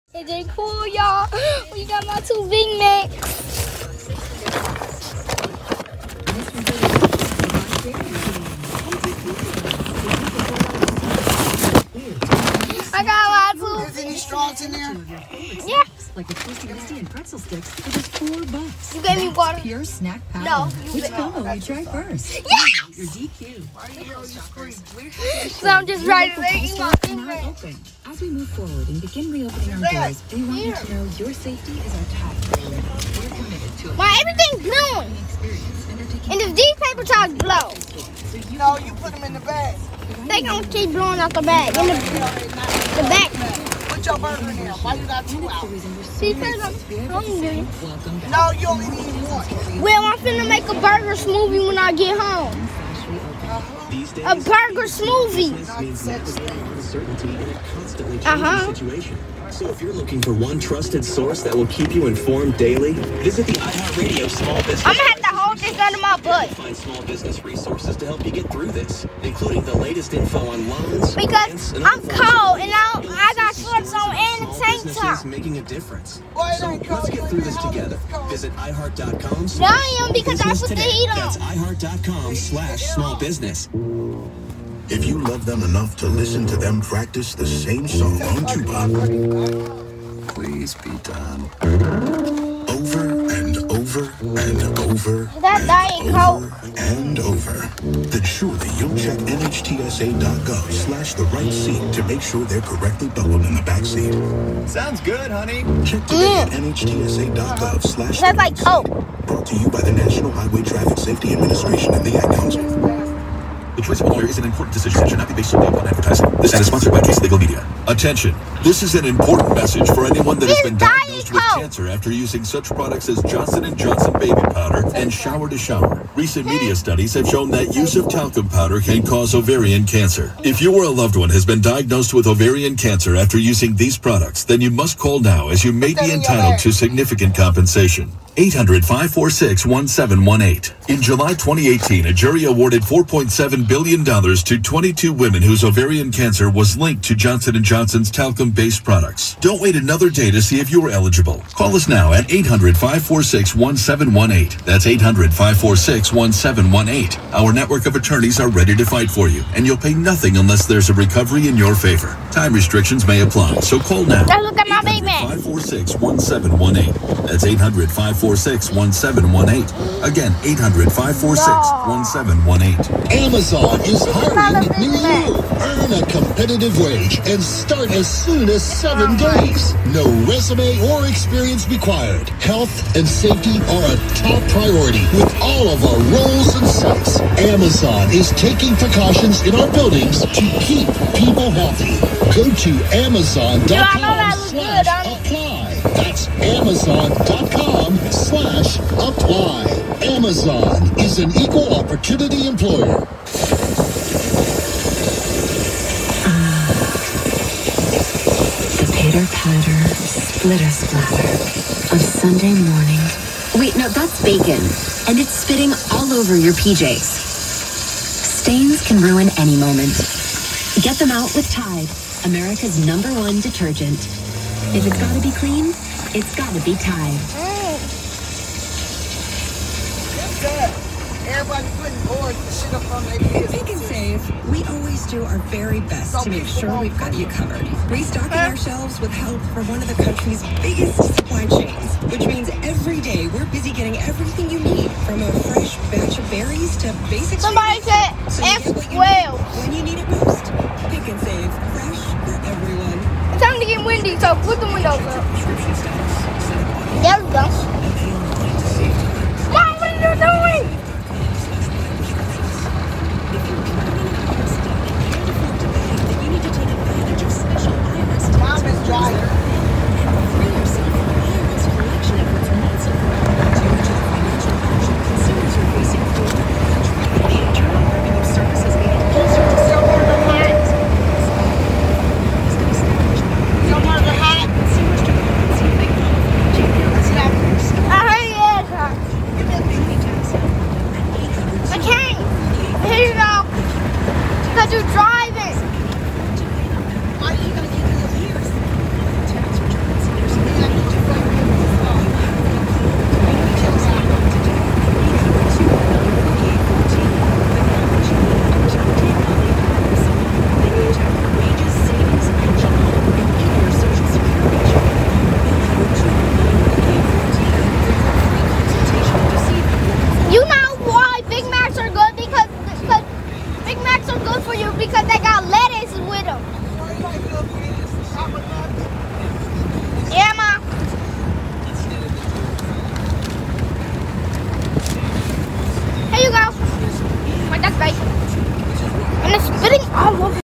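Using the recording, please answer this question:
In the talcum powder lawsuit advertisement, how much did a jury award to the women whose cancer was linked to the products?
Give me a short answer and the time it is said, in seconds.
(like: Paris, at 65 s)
$4.7 billion, at 142 s.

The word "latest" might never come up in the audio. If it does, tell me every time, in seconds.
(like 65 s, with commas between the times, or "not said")
69 s.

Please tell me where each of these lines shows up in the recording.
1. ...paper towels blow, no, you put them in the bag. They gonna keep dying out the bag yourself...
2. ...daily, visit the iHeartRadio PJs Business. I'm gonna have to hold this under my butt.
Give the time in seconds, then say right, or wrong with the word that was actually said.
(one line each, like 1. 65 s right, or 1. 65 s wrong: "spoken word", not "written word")
1. 36 s wrong: "blowing", not "dying"
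2. 62 s wrong: "Small", not "PJs".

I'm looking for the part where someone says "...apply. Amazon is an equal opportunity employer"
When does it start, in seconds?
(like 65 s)
198 s.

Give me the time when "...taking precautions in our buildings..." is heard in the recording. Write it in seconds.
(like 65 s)
188 s.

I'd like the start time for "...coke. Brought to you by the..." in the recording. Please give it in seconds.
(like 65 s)
108 s.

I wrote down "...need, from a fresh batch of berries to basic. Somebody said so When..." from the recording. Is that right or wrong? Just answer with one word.
right.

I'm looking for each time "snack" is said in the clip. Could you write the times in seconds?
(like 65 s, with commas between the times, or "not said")
19 s.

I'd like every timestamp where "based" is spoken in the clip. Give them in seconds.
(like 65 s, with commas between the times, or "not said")
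115 s, 148 s.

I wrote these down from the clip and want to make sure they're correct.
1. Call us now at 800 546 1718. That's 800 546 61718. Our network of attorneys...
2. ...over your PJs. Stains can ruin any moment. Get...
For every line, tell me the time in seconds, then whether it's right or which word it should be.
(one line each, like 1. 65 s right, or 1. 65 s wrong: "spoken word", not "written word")
1. 151 s right
2. 216 s right.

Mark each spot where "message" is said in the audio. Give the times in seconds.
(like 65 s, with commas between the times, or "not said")
119 s.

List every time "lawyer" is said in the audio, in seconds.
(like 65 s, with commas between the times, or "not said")
114 s.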